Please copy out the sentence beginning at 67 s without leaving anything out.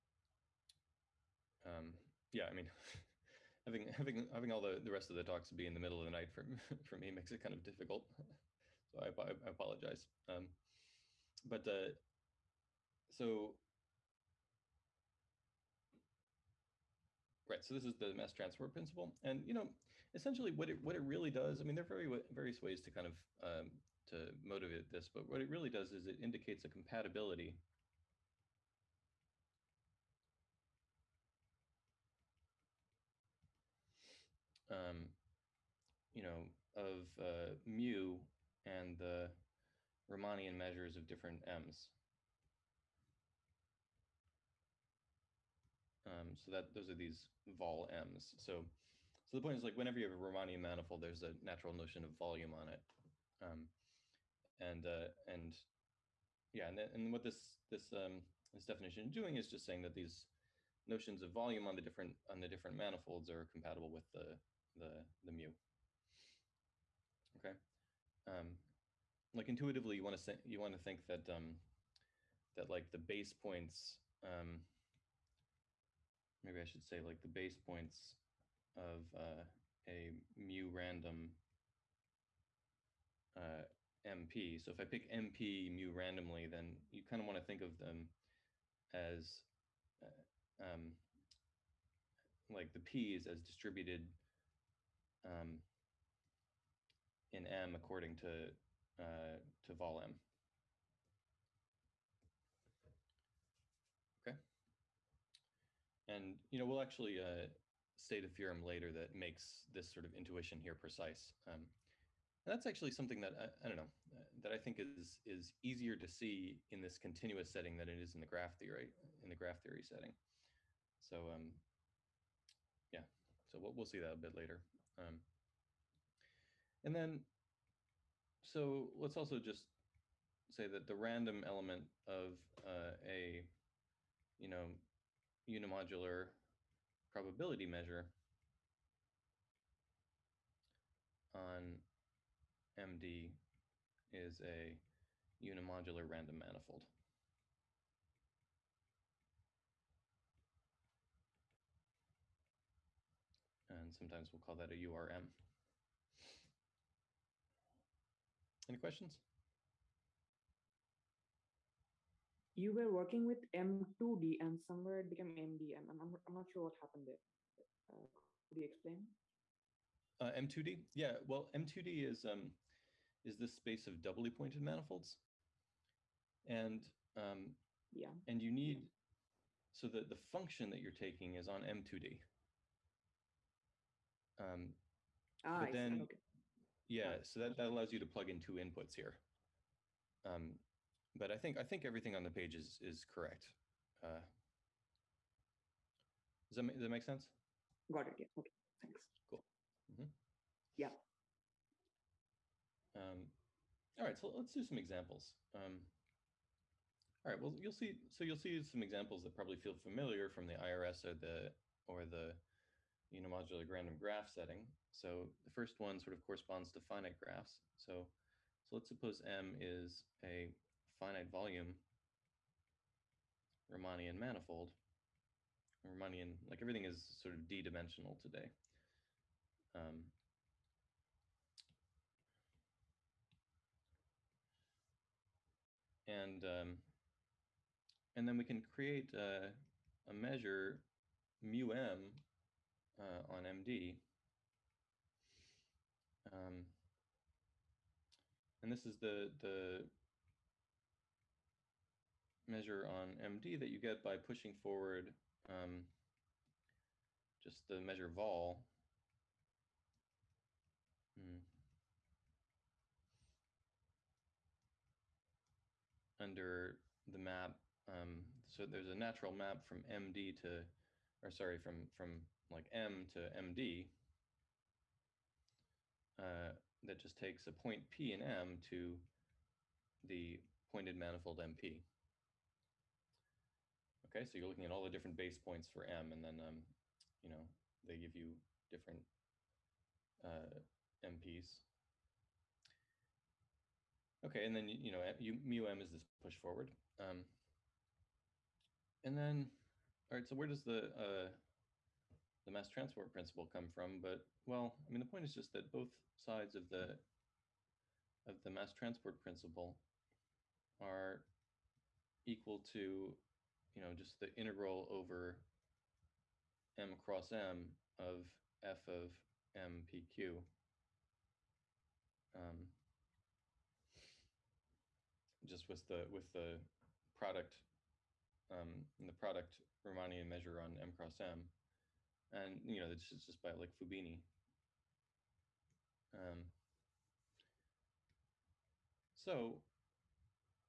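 Okay, um, like intuitively, you want to you want to think that um, that like the base points.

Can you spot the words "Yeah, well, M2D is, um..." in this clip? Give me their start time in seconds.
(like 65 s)
170 s.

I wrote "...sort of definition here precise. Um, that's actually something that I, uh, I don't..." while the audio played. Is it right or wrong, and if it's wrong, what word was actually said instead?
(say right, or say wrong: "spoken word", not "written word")
wrong: "intuition", not "definition".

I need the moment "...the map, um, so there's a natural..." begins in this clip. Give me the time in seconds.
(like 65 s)
267 s.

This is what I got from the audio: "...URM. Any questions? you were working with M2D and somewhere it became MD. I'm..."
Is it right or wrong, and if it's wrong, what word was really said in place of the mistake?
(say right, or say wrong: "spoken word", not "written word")
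right.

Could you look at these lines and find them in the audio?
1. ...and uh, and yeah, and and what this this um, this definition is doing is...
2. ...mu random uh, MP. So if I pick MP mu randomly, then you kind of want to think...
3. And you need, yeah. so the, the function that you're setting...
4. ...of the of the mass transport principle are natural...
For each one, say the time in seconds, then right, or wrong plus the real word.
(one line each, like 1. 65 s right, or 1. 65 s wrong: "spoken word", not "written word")
1. 54 s right
2. 80 s right
3. 178 s wrong: "taking", not "setting"
4. 306 s wrong: "equal", not "natural".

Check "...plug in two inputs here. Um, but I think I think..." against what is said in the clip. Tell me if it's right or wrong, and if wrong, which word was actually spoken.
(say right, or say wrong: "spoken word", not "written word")
right.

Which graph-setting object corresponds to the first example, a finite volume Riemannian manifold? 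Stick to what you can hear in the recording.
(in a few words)
finite graphs.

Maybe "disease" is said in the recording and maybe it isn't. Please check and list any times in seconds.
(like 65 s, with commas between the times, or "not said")
not said.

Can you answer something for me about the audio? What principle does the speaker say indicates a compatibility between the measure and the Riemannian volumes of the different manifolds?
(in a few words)
mass transfer principle.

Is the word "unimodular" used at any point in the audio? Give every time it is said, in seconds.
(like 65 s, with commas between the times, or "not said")
135 s, 145 s, 213 s.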